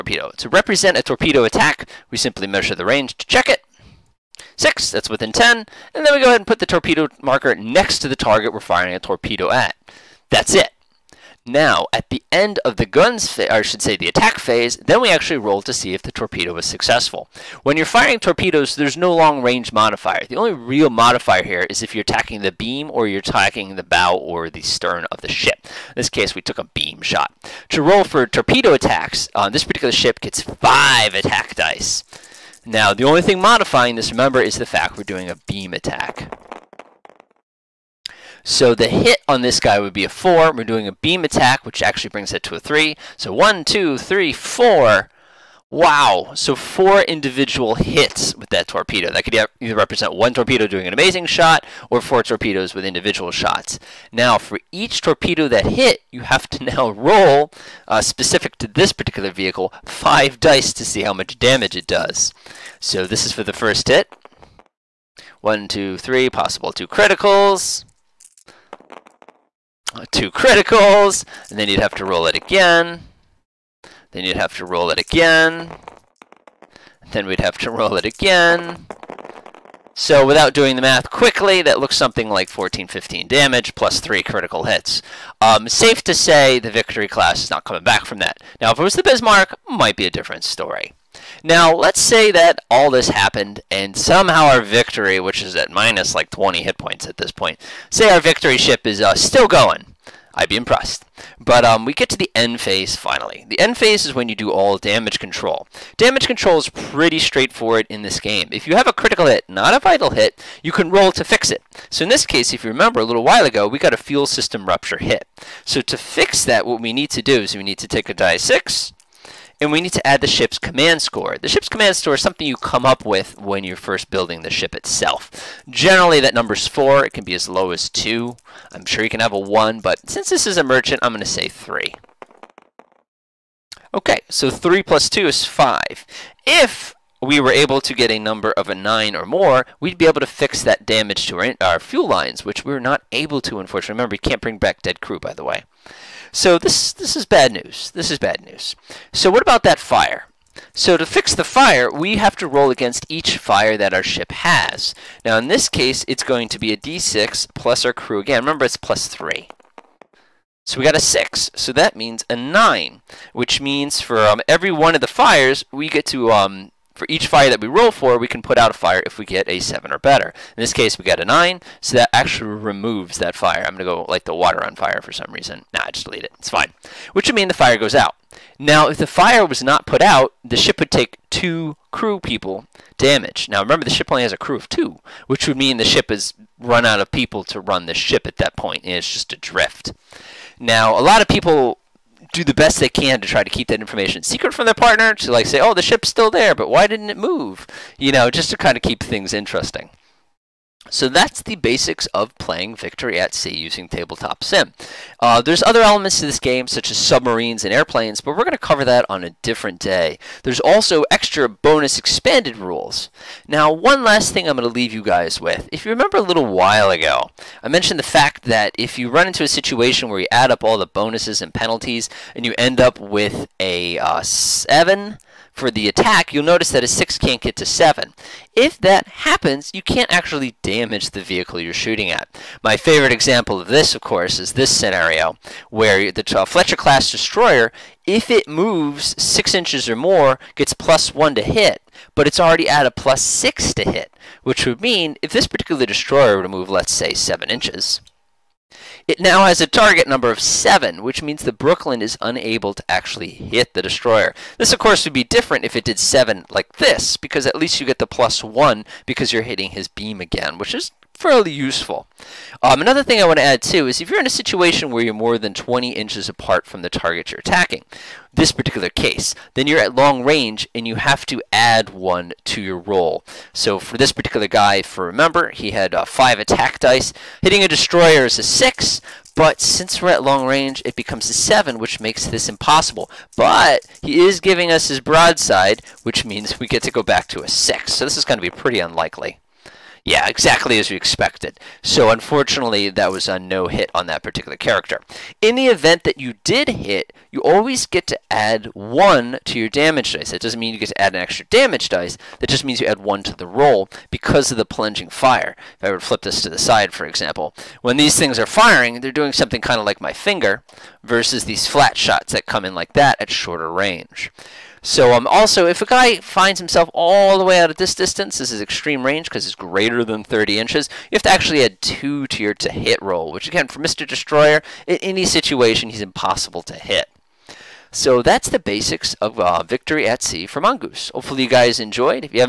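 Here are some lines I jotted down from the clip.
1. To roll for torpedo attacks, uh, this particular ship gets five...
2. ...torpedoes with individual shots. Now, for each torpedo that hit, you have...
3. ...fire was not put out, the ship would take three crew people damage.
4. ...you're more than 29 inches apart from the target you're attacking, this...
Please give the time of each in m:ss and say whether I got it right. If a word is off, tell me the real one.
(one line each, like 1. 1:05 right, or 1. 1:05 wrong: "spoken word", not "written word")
1. 0:27 right
2. 0:52 right
3. 2:59 wrong: "two", not "three"
4. 4:25 wrong: "20", not "29".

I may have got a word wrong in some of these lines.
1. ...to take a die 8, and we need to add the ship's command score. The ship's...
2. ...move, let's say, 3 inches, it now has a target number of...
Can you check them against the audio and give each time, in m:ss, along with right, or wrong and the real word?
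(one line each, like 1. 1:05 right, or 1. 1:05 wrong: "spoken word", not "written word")
1. 1:57 wrong: "6", not "8"
2. 4:06 wrong: "7", not "3".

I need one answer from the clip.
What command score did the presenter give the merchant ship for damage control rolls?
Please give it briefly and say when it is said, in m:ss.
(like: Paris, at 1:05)
3, at 2:11.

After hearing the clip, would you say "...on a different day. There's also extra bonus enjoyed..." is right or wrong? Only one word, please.
wrong.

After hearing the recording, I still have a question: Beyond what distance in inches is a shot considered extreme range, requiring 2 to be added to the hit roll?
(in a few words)
30 inches.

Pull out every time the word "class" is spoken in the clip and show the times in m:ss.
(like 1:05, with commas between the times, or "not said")
1:27, 3:56.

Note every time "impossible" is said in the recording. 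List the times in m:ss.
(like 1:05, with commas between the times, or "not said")
4:42, 5:26.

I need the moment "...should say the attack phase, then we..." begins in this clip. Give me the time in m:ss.
0:13.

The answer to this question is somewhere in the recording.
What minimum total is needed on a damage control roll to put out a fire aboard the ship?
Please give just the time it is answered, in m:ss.
2:49.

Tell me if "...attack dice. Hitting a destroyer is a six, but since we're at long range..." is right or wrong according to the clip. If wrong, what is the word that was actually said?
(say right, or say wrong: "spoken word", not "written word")
right.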